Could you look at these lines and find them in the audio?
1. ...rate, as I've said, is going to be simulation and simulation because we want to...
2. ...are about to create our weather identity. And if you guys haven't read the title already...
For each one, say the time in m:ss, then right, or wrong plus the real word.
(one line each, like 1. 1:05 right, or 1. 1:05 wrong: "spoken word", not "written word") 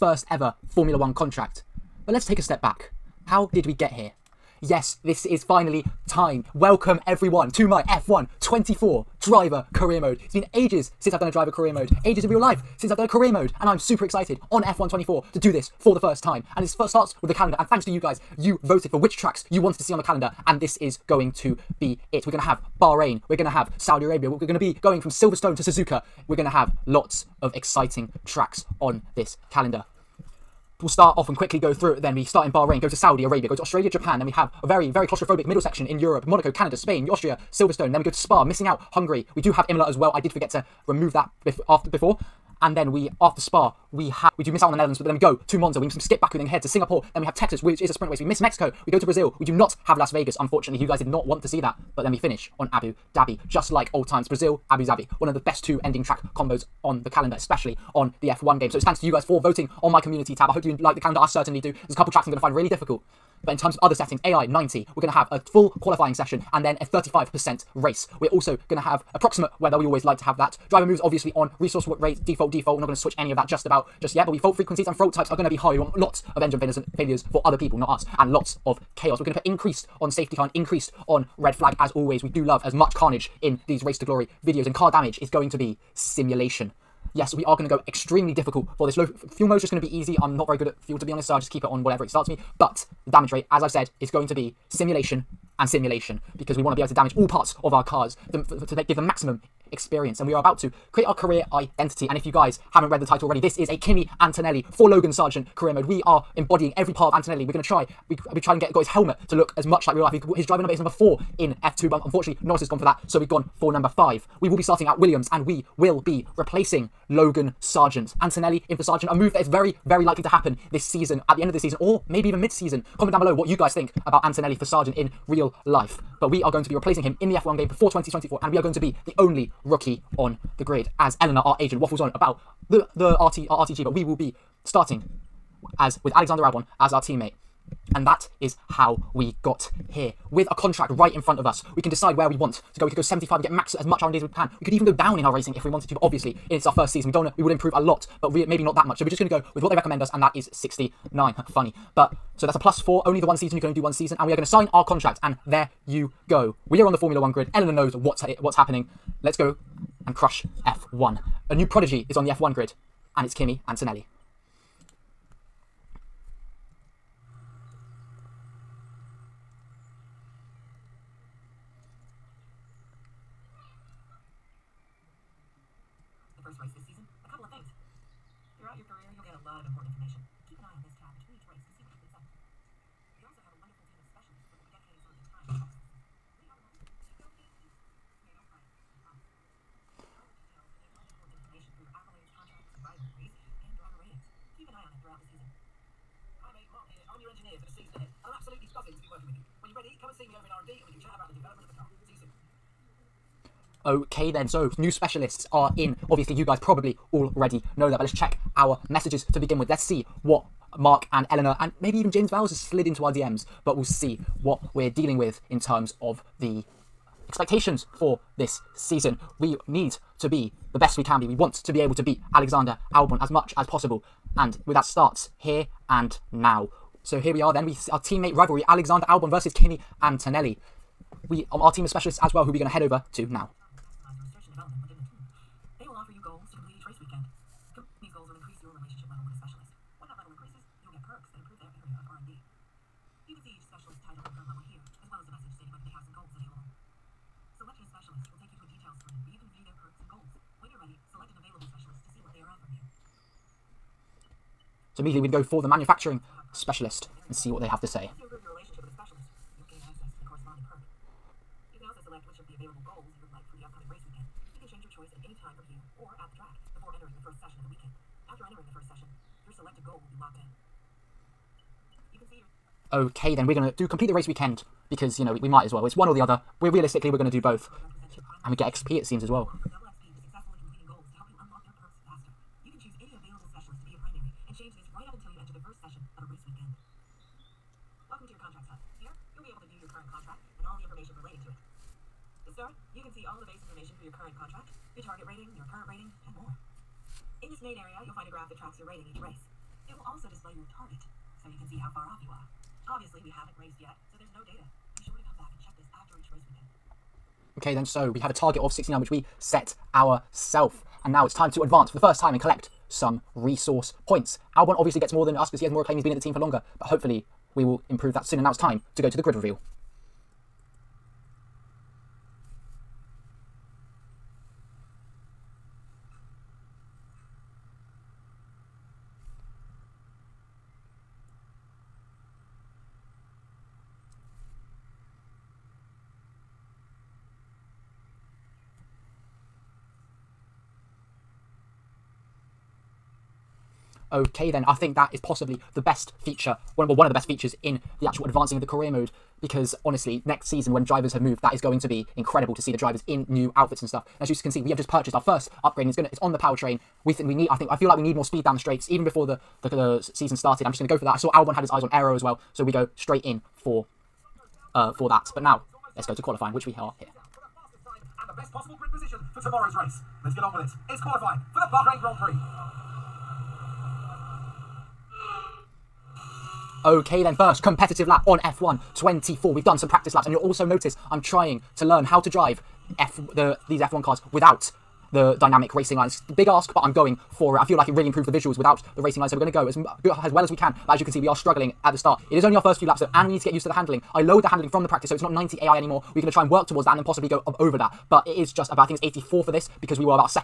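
1. 1:33 right
2. 1:40 wrong: "career", not "weather".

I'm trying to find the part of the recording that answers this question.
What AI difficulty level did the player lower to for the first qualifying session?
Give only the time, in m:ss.
6:39.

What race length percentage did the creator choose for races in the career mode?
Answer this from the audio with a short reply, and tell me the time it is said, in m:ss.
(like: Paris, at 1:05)
35%, at 1:06.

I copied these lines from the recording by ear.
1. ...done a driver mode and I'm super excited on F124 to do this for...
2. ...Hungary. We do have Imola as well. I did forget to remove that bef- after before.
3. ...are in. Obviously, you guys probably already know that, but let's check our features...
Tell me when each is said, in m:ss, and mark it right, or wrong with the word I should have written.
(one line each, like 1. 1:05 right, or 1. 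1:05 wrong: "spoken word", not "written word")
1. 0:12 wrong: "career", not "driver"
2. 0:38 right
3. 3:25 wrong: "messages", not "features".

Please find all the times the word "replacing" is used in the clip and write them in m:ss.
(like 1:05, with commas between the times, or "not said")
1:56, 2:06.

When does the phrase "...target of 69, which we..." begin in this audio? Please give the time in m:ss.
5:08.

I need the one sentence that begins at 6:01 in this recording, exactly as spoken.
I saw Albon had his eyes on Aero as well, so we go straight in for uh, for that.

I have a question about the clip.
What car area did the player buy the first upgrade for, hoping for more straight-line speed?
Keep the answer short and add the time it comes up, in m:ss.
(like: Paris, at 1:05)
Powertrain, at 5:56.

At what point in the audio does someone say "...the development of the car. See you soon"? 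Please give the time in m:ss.
3:21.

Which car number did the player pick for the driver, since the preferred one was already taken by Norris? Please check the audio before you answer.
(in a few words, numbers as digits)
5.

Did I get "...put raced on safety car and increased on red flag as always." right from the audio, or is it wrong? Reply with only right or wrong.
wrong.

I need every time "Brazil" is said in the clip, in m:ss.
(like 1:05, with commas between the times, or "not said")
0:49, 0:54.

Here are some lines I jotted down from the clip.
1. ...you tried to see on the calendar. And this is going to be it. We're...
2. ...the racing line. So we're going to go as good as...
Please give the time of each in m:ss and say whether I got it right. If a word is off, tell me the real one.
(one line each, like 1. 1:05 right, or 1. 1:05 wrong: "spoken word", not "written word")
1. 0:19 wrong: "wanted", not "tried"
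2. 6:28 right.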